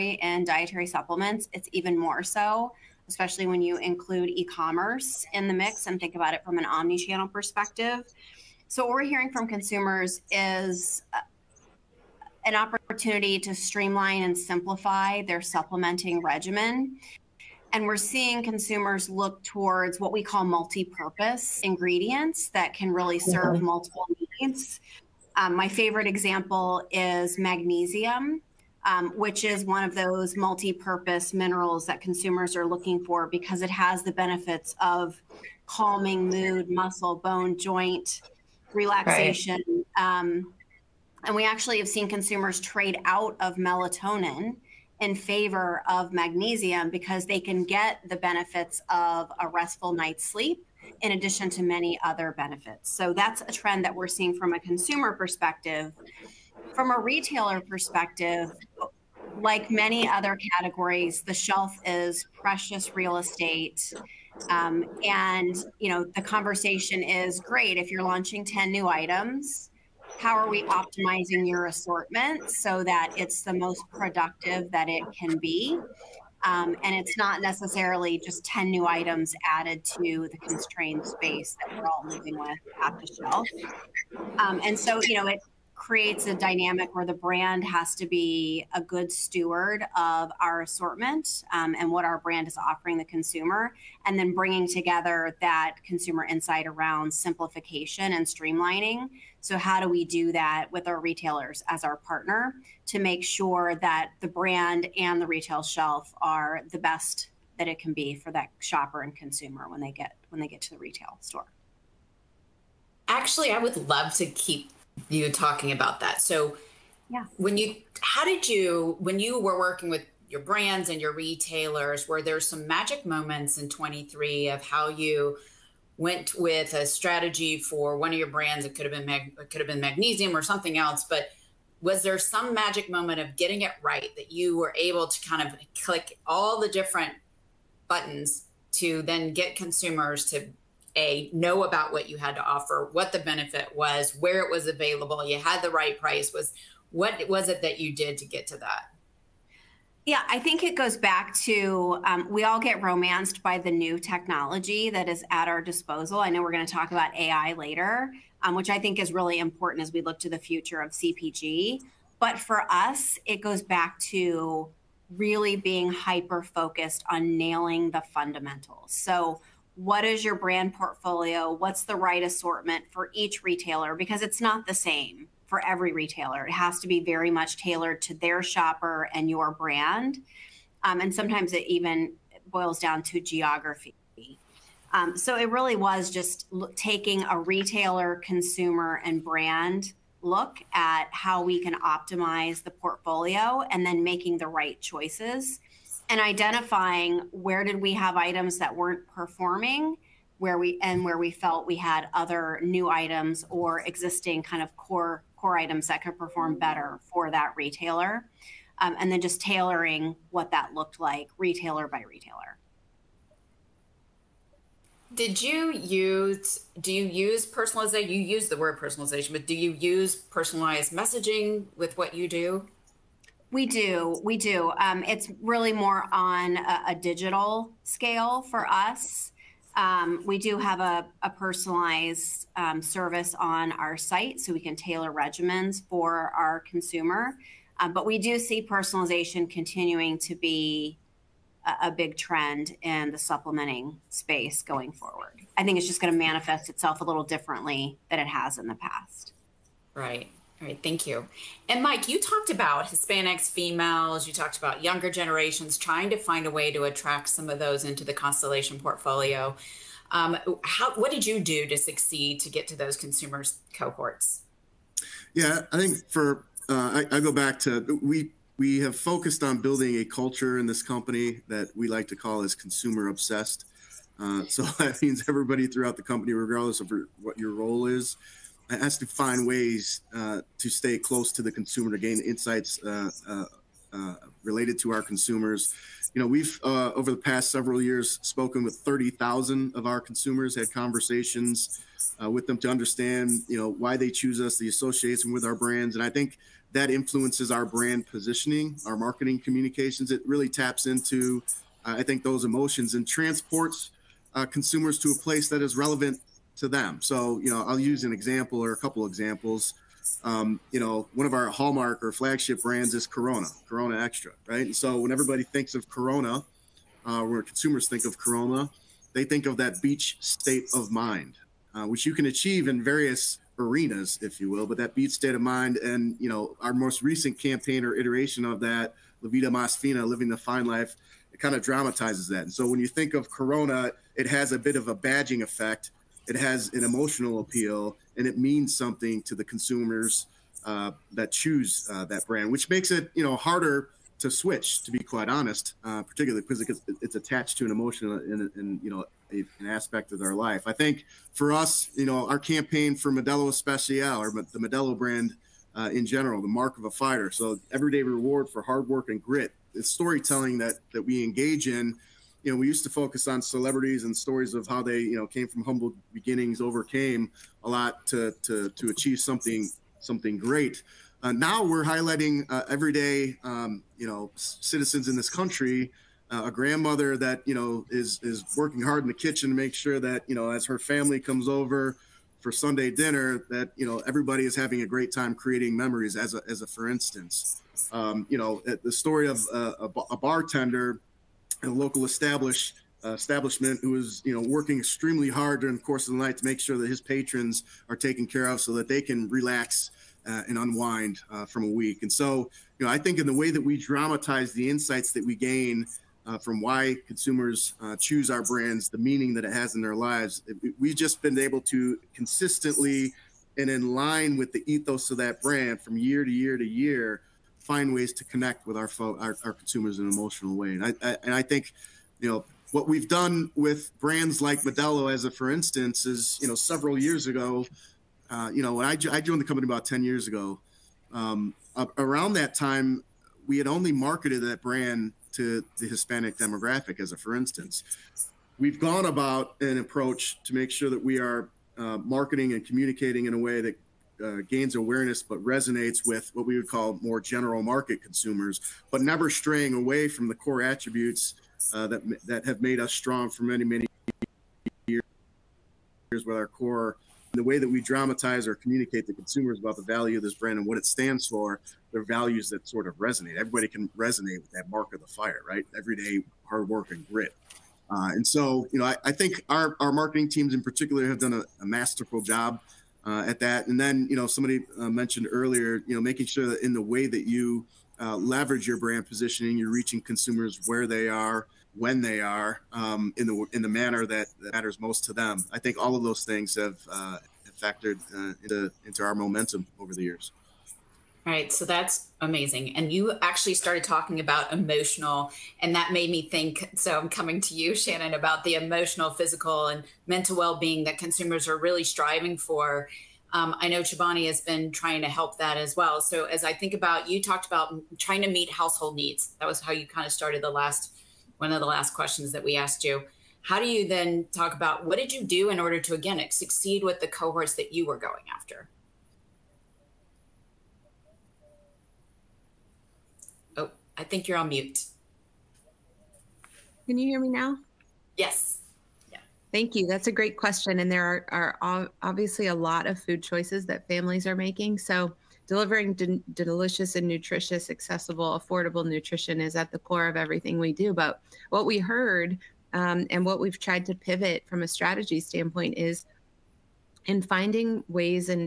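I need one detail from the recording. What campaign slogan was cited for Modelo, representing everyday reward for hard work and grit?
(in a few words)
the mark of a fighter.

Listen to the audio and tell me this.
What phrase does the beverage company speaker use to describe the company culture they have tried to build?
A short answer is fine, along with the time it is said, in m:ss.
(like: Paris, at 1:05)
consumer obsessed, at 4:32.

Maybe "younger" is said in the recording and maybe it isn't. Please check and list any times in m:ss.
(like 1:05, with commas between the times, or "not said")
4:14.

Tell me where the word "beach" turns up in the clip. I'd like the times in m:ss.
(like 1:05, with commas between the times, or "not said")
5:19, 5:24.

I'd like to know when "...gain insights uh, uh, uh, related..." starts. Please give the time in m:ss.
4:41.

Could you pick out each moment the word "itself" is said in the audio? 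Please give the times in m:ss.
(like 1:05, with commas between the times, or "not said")
4:06.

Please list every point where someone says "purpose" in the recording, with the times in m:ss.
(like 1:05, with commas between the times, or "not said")
0:20, 0:30.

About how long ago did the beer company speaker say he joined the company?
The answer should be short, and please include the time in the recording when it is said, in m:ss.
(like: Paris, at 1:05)
10 years, at 7:09.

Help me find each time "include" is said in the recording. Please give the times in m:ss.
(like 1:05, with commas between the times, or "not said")
0:03.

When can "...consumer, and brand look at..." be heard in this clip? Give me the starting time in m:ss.
3:08.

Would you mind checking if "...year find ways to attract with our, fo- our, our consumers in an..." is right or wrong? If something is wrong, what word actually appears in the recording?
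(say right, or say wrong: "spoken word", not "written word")
wrong: "connect", not "attract".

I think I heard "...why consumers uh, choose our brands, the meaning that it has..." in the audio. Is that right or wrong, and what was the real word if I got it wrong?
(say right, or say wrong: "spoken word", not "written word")
right.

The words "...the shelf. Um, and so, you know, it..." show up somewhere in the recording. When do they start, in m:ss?
1:22.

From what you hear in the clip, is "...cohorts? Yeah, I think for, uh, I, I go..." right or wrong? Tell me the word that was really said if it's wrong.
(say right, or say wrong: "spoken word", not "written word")
right.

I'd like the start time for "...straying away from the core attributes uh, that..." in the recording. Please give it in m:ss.
7:29.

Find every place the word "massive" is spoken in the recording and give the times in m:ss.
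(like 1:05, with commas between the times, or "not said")
not said.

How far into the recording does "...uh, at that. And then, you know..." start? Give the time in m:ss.
7:53.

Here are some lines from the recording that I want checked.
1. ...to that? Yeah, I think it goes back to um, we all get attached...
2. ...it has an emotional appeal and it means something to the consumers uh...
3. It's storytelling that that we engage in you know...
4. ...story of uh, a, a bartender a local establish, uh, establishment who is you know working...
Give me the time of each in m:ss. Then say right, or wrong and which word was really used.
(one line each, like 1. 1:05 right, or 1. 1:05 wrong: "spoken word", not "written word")
1. 2:28 wrong: "romanced", not "attached"
2. 5:36 right
3. 5:59 right
4. 6:28 right.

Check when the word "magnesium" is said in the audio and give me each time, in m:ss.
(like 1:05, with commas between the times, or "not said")
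0:27, 0:46, 2:09.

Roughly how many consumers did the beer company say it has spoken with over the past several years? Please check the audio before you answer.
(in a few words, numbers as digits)
30,000.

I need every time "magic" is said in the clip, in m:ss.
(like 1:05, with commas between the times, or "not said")
2:02, 2:12.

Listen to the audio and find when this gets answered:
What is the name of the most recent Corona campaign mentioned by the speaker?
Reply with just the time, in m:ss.
5:29.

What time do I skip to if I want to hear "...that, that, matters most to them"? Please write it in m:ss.
8:04.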